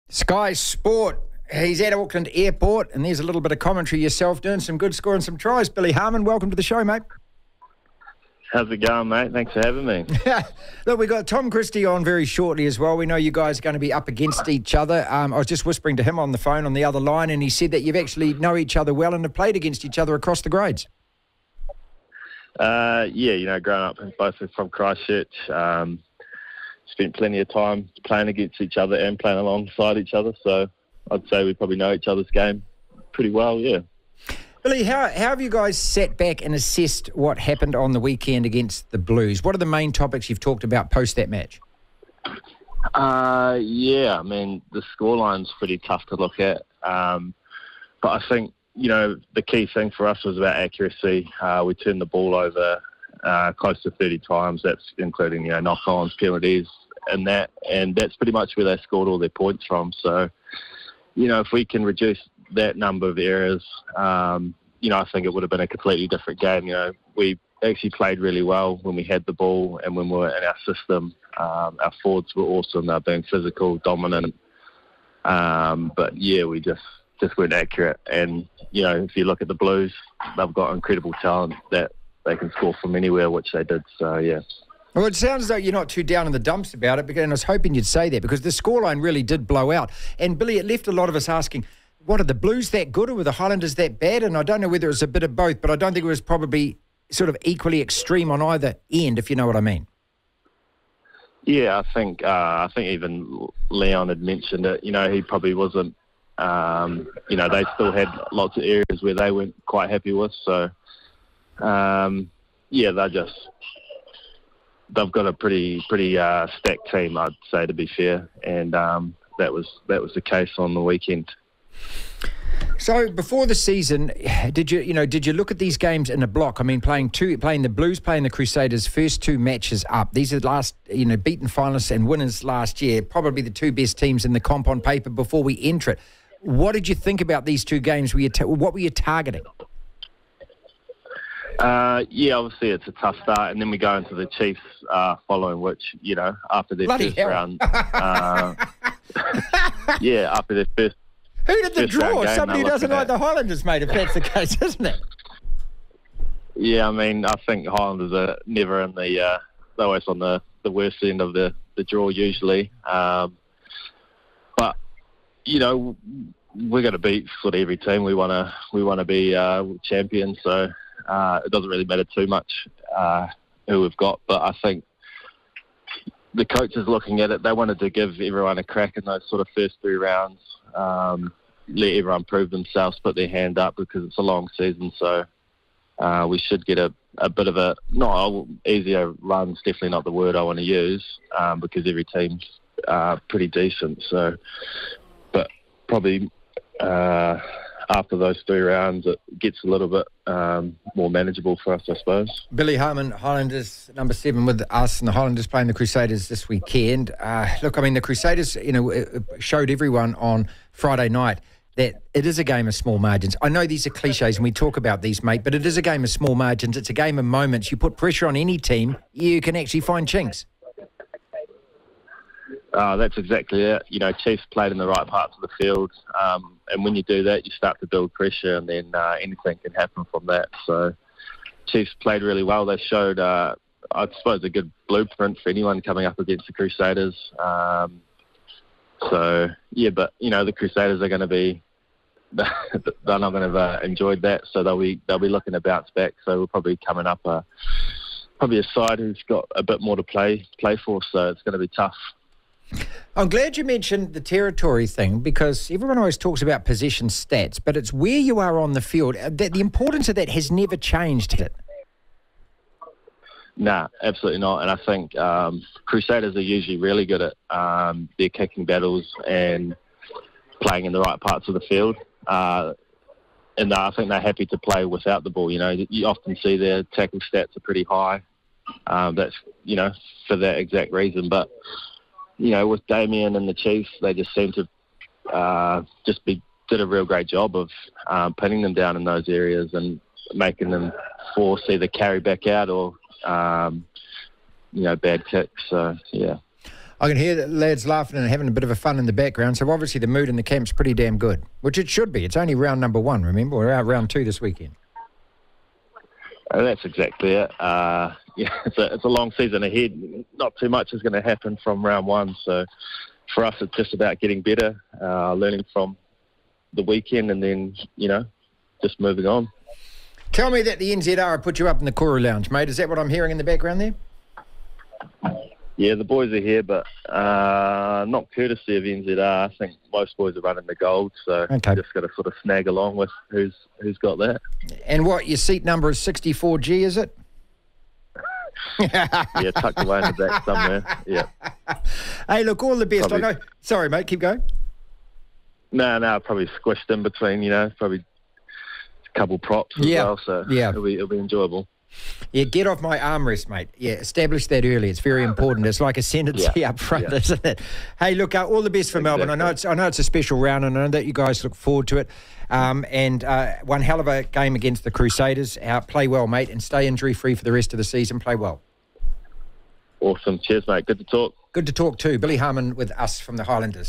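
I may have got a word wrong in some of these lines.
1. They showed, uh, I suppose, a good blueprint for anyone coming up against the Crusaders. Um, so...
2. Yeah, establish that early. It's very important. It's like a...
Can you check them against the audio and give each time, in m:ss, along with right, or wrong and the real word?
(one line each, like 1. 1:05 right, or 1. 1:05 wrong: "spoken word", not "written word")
1. 3:52 right
2. 5:53 right.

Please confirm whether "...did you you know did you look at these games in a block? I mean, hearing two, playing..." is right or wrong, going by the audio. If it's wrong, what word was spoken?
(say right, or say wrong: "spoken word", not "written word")
wrong: "playing", not "hearing".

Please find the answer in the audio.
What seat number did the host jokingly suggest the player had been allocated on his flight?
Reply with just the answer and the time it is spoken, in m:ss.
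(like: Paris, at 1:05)
64G, at 5:35.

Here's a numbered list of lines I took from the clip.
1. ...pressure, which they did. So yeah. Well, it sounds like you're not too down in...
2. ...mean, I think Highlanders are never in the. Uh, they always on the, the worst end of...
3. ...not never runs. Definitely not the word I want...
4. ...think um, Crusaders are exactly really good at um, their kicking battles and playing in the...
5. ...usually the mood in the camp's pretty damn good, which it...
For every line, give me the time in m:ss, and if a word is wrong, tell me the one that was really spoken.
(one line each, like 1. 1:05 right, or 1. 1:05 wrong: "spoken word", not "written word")
1. 1:22 wrong: "anywhere", not "pressure"
2. 2:36 right
3. 3:07 wrong: "easier", not "never"
4. 4:24 wrong: "usually", not "exactly"
5. 4:59 wrong: "obviously", not "usually".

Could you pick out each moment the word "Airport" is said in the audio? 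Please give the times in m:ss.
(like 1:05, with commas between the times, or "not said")
0:02.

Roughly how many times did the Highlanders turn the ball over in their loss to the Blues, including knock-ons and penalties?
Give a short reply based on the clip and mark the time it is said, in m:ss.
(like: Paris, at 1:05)
30, at 0:53.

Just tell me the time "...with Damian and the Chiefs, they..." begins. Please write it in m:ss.
4:42.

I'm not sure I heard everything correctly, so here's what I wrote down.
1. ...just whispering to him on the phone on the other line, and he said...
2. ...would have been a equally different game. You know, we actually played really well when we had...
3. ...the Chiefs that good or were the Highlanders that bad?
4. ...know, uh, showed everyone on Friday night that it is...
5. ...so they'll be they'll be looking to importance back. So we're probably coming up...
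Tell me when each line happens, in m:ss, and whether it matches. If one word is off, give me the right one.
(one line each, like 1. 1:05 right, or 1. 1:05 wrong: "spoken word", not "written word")
1. 0:15 right
2. 1:05 wrong: "completely", not "equally"
3. 1:32 wrong: "Blues", not "Chiefs"
4. 3:28 right
5. 4:04 wrong: "bounce", not "importance".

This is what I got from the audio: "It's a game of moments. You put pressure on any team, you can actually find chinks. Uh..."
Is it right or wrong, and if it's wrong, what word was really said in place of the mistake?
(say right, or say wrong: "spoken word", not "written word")
right.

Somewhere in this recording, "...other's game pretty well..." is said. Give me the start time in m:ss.
0:32.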